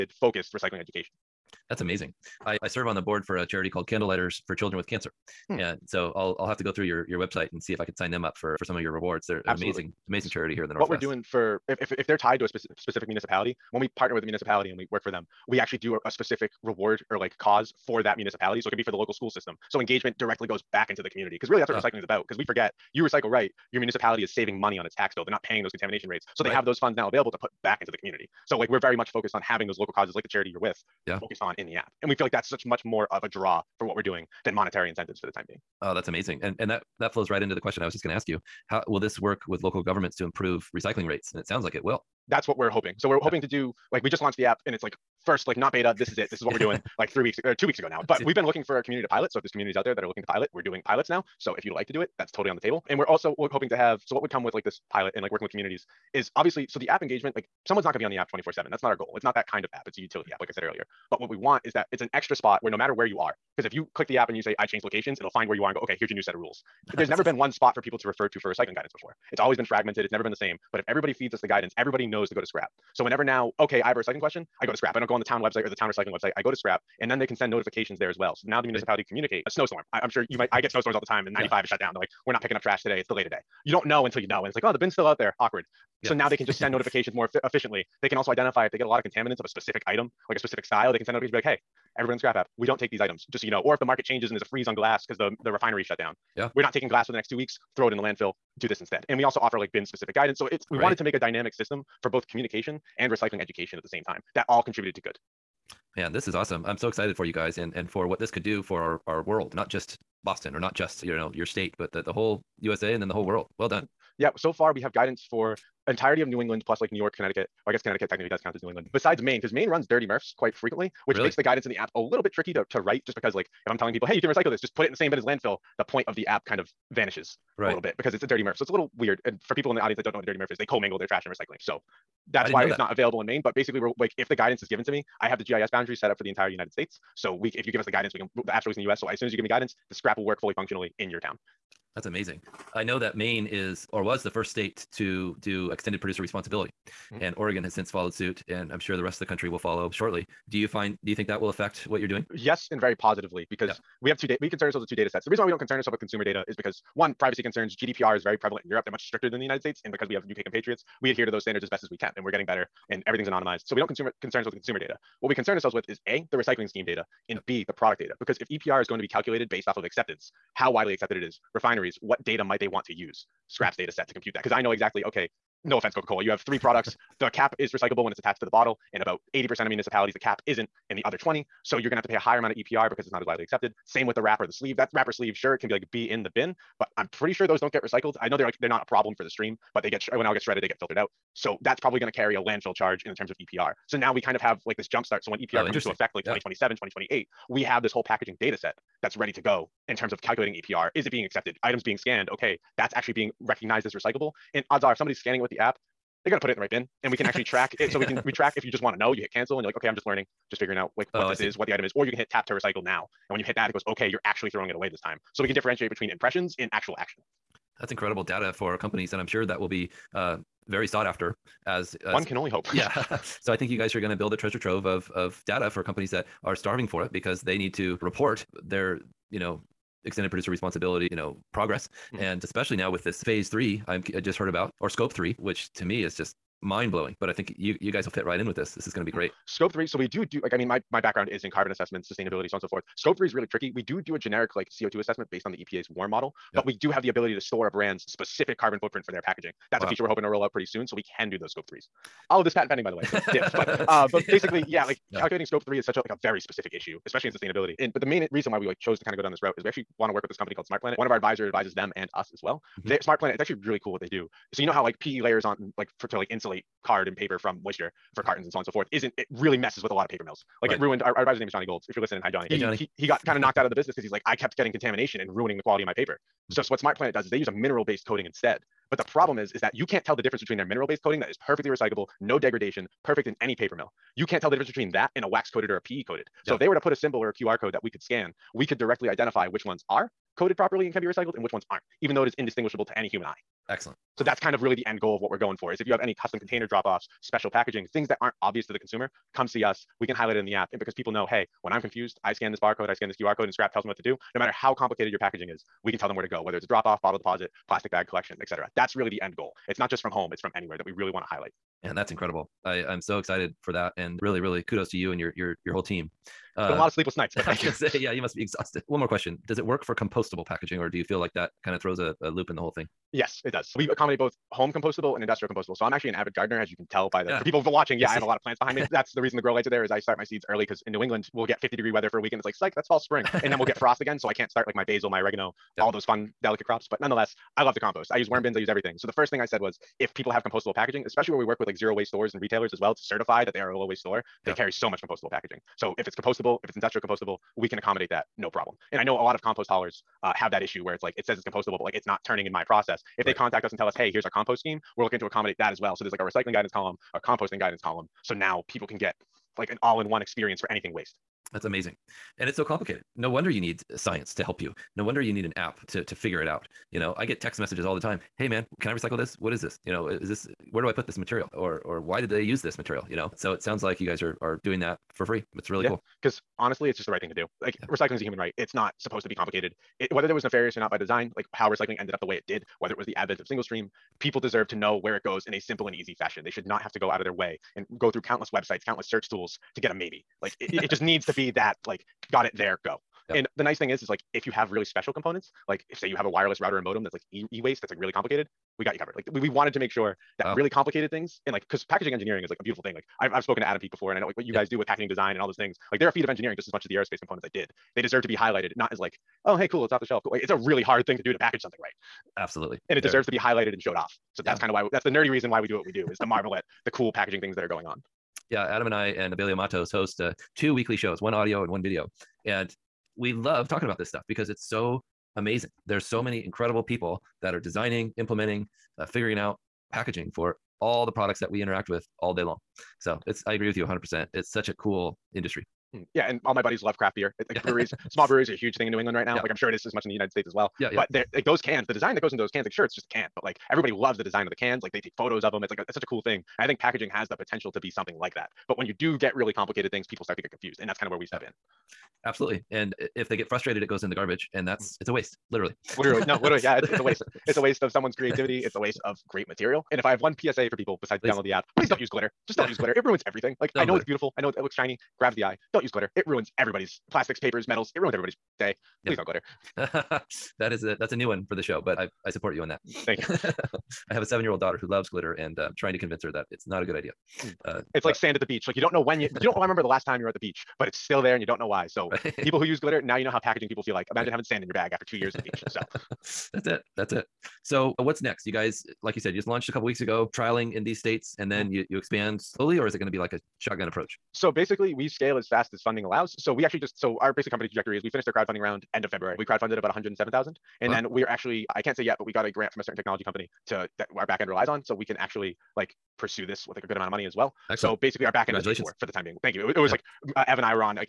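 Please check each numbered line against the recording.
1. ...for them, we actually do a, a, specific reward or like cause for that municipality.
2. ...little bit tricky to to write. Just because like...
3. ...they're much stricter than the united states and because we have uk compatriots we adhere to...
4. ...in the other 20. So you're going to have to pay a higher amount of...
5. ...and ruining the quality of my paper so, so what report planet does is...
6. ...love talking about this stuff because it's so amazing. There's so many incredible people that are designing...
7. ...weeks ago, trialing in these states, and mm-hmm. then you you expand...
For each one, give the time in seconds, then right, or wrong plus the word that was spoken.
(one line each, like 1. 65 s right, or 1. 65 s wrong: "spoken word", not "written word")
1. 15 s right
2. 121 s right
3. 158 s right
4. 180 s right
5. 275 s wrong: "smart", not "report"
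6. 423 s right
7. 489 s right.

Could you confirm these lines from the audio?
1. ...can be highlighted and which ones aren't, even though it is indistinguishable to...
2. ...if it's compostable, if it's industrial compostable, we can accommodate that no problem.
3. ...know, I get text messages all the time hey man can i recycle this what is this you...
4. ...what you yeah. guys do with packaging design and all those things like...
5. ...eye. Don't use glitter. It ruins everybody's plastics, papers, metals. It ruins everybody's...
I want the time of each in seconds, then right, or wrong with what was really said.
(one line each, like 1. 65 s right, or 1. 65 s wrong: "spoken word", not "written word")
1. 290 s wrong: "recycled", not "highlighted"
2. 345 s right
3. 366 s right
4. 404 s right
5. 465 s right.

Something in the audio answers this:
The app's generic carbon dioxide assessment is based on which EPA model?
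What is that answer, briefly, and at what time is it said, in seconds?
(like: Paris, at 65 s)
WARM model, at 245 s.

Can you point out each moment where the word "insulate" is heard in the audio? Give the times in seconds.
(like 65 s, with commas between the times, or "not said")
266 s.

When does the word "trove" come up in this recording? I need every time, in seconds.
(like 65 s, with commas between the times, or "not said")
224 s.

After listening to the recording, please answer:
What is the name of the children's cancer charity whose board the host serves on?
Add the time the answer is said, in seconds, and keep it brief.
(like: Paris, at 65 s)
Candlelighters for Children with Cancer, at 3 s.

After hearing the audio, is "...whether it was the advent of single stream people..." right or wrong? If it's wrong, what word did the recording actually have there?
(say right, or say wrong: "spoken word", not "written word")
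right.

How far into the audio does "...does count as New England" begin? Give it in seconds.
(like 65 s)
118 s.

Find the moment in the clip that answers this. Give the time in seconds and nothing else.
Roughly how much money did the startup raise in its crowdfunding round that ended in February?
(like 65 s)
499 s.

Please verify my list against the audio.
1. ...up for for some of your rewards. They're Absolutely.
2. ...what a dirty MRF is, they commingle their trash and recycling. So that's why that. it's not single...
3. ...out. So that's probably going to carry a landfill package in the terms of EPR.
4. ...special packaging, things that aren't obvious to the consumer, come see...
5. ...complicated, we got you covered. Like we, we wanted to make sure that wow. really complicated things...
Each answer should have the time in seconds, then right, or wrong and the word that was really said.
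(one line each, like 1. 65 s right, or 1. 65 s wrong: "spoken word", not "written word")
1. 8 s right
2. 130 s wrong: "available", not "single"
3. 190 s wrong: "charge", not "package"
4. 297 s right
5. 398 s right.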